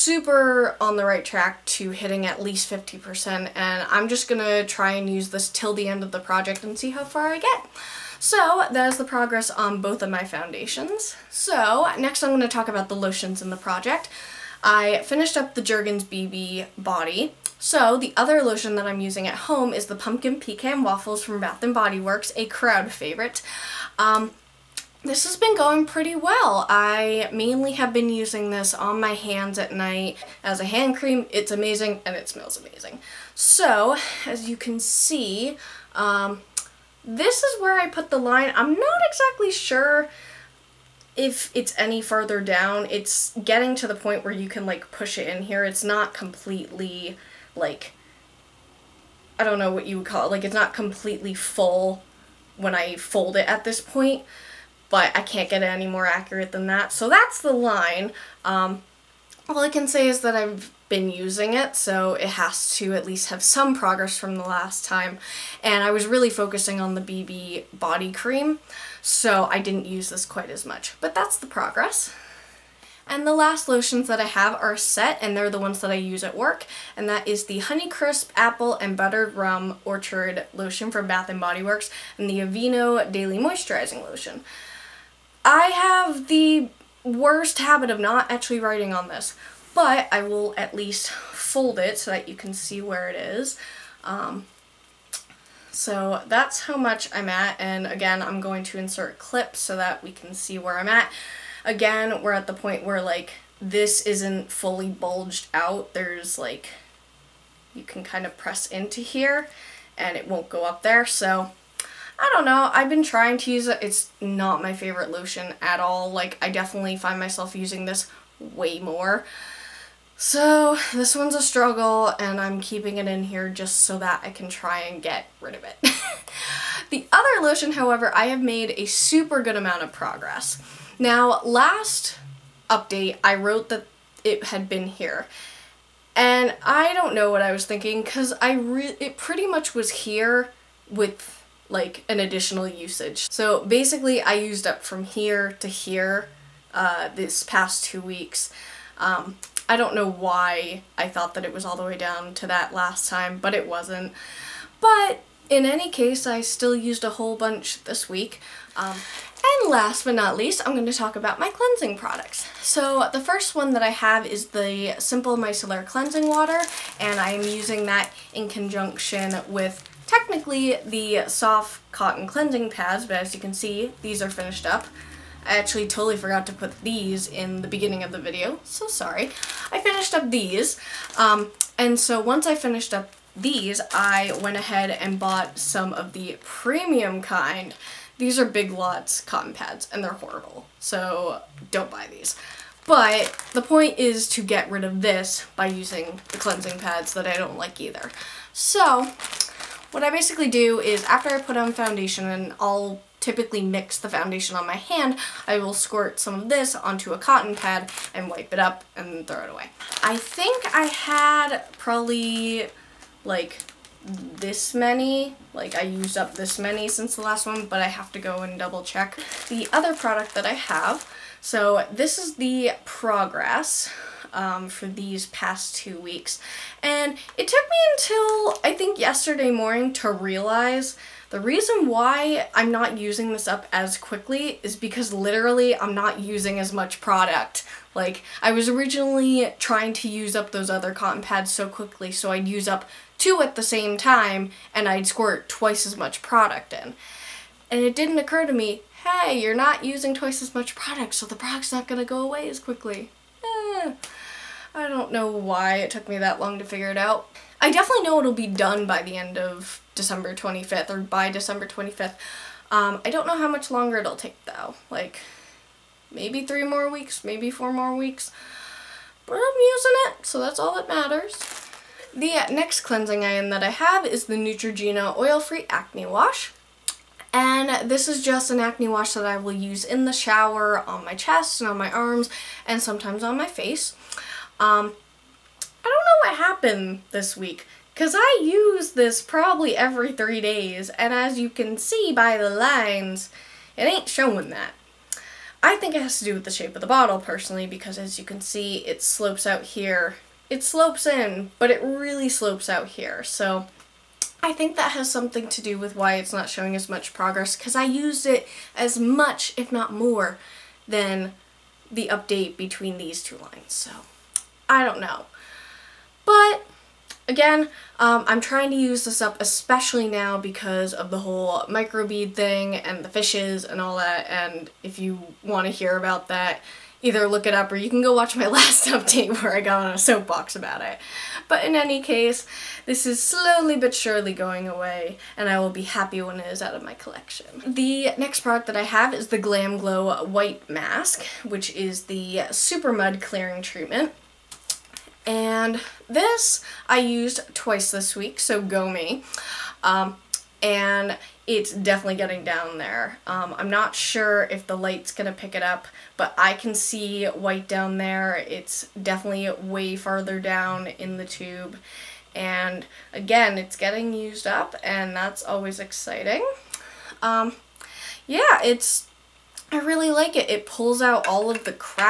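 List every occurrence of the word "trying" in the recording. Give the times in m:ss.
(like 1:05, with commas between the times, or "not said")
1:53, 3:59, 5:18.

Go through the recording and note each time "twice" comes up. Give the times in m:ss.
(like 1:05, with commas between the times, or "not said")
4:05, 4:10, 5:47.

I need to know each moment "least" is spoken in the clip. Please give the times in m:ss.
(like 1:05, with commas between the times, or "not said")
0:02, 1:03, 1:30, 2:40.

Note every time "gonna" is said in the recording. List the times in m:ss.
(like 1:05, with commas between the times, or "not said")
0:04, 4:11, 5:55.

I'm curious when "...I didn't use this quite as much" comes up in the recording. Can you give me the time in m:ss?
1:09.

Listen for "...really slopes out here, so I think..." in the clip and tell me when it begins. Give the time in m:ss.
5:01.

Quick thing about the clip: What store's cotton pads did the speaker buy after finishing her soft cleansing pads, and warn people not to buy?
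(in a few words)
Big Lots.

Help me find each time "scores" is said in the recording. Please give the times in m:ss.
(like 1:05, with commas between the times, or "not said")
not said.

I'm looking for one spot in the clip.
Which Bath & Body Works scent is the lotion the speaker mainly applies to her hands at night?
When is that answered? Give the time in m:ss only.
0:19.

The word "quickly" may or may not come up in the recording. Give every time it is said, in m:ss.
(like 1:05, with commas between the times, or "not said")
3:53, 4:01, 4:12.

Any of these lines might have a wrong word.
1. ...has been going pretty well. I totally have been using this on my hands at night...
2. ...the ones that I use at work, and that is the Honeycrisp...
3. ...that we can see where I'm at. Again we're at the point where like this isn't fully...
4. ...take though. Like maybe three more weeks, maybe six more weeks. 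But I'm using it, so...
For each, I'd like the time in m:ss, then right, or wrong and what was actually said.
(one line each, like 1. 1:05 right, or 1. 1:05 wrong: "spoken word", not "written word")
1. 0:25 wrong: "mainly", not "totally"
2. 1:15 right
3. 1:39 right
4. 4:24 wrong: "four", not "six".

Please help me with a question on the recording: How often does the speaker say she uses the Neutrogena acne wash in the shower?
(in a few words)
every three days.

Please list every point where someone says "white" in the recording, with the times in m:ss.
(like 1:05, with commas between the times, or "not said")
5:40, 5:57.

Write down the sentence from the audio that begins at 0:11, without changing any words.
So next I'm going to talk about the lotions in the project.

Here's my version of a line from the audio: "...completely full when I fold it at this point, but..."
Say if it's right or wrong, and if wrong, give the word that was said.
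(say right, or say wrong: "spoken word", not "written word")
right.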